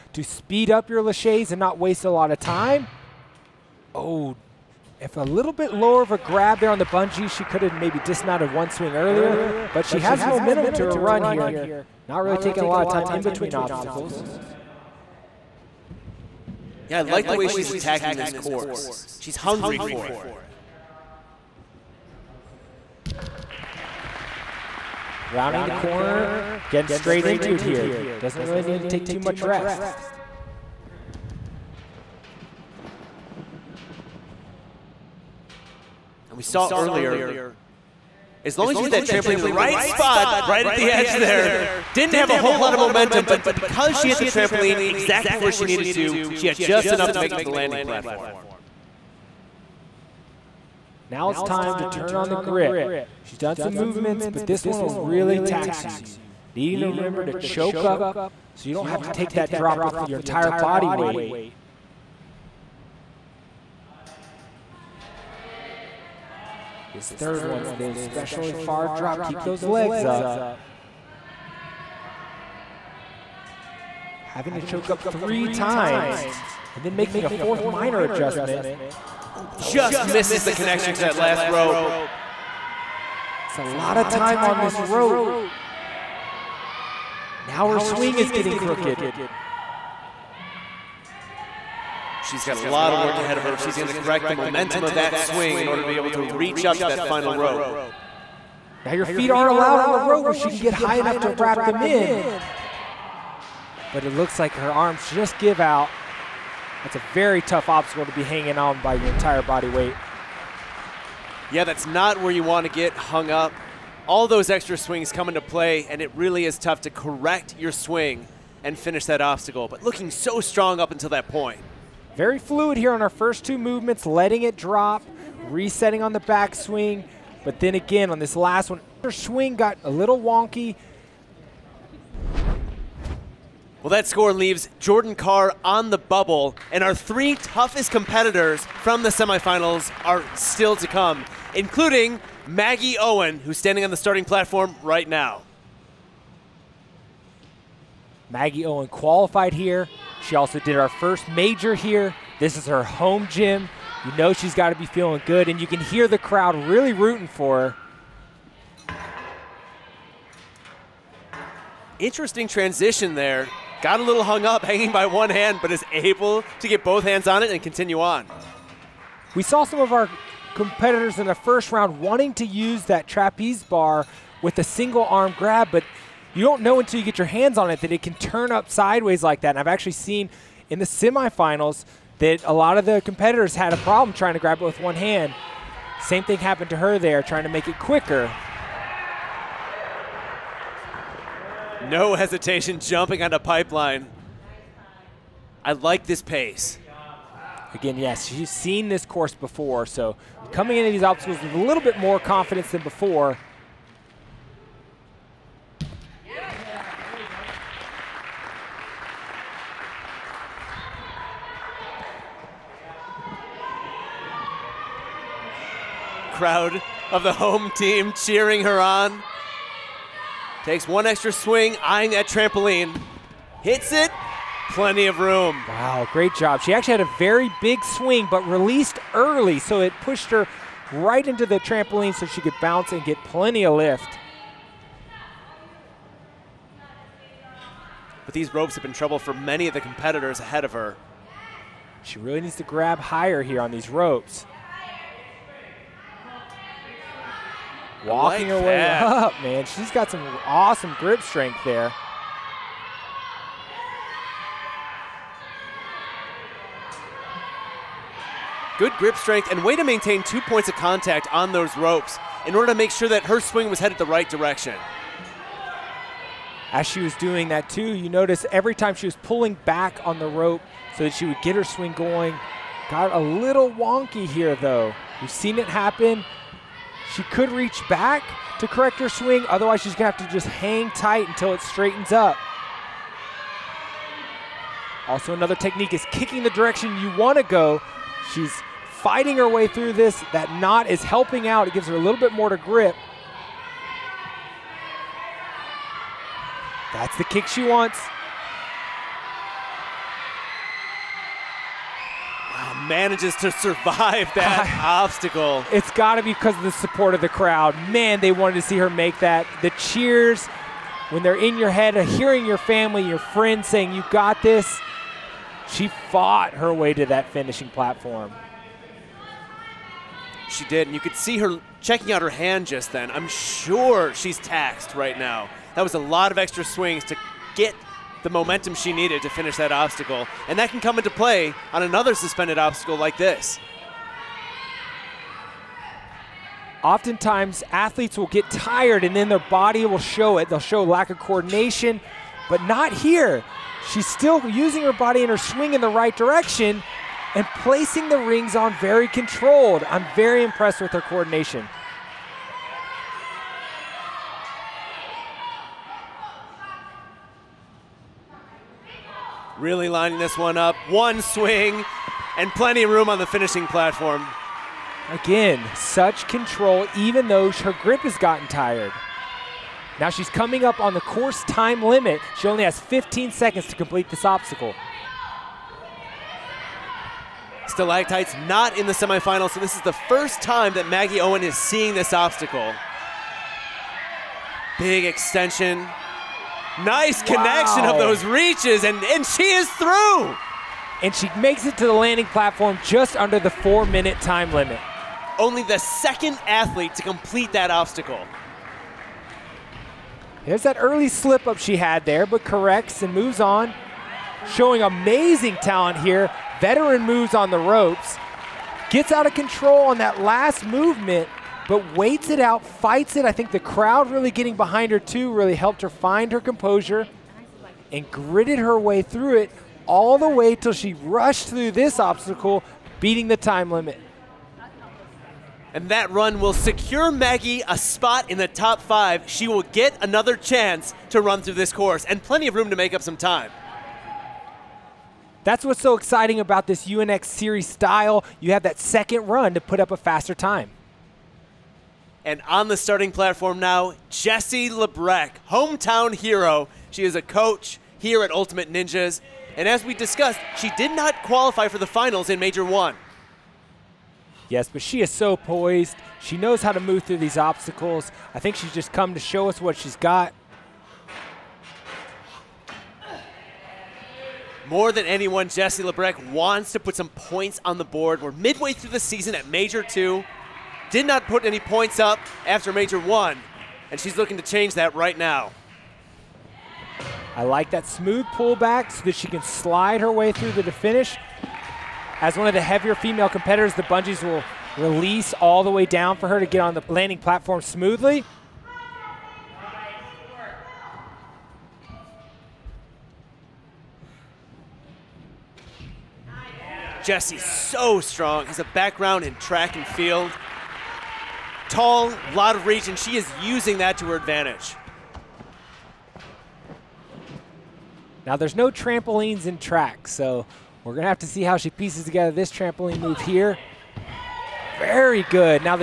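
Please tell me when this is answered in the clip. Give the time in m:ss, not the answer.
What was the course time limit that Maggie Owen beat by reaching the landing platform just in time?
6:33.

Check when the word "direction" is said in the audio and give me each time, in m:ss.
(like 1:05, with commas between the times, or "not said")
4:24, 4:46, 5:46.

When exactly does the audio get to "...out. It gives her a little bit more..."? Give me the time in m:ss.
4:51.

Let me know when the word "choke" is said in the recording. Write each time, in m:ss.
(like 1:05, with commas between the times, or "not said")
0:57, 1:14.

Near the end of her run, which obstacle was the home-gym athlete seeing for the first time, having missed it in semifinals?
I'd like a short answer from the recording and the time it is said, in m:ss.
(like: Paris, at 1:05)
Stalactites, at 6:17.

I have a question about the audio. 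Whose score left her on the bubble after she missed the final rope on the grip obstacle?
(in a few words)
Jordan Carr.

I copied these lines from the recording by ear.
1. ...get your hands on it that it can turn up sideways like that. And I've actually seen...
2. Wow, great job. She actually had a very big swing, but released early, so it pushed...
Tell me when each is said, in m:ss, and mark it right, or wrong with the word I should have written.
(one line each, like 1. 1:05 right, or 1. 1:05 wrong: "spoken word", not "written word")
1. 2:57 right
2. 3:45 right.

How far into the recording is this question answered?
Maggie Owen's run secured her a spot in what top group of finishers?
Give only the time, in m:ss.
7:08.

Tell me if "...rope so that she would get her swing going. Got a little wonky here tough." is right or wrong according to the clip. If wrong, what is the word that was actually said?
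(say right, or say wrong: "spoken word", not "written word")
wrong: "though", not "tough".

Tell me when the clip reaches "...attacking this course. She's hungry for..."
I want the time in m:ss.
0:17.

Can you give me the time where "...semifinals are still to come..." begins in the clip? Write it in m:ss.
2:19.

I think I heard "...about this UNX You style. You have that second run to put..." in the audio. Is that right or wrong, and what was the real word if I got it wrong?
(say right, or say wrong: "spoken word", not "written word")
wrong: "Series", not "You".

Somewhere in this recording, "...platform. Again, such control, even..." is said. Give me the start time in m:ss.
6:03.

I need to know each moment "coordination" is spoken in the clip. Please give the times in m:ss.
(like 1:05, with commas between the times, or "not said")
5:41, 5:50.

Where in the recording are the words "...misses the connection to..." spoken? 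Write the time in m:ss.
1:20.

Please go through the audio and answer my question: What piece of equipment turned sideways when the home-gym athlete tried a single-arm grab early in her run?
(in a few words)
trapeze bar.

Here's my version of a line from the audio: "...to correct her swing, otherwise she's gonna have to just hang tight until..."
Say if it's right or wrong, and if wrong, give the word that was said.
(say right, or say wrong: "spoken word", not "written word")
right.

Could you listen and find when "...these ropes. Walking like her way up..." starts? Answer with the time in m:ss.
4:03.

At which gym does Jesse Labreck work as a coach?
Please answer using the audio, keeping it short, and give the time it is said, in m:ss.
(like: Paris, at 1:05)
Ultimate Ninjas, at 7:28.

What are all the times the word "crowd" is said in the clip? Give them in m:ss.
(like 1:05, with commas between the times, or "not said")
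2:36, 3:36, 5:07, 6:53.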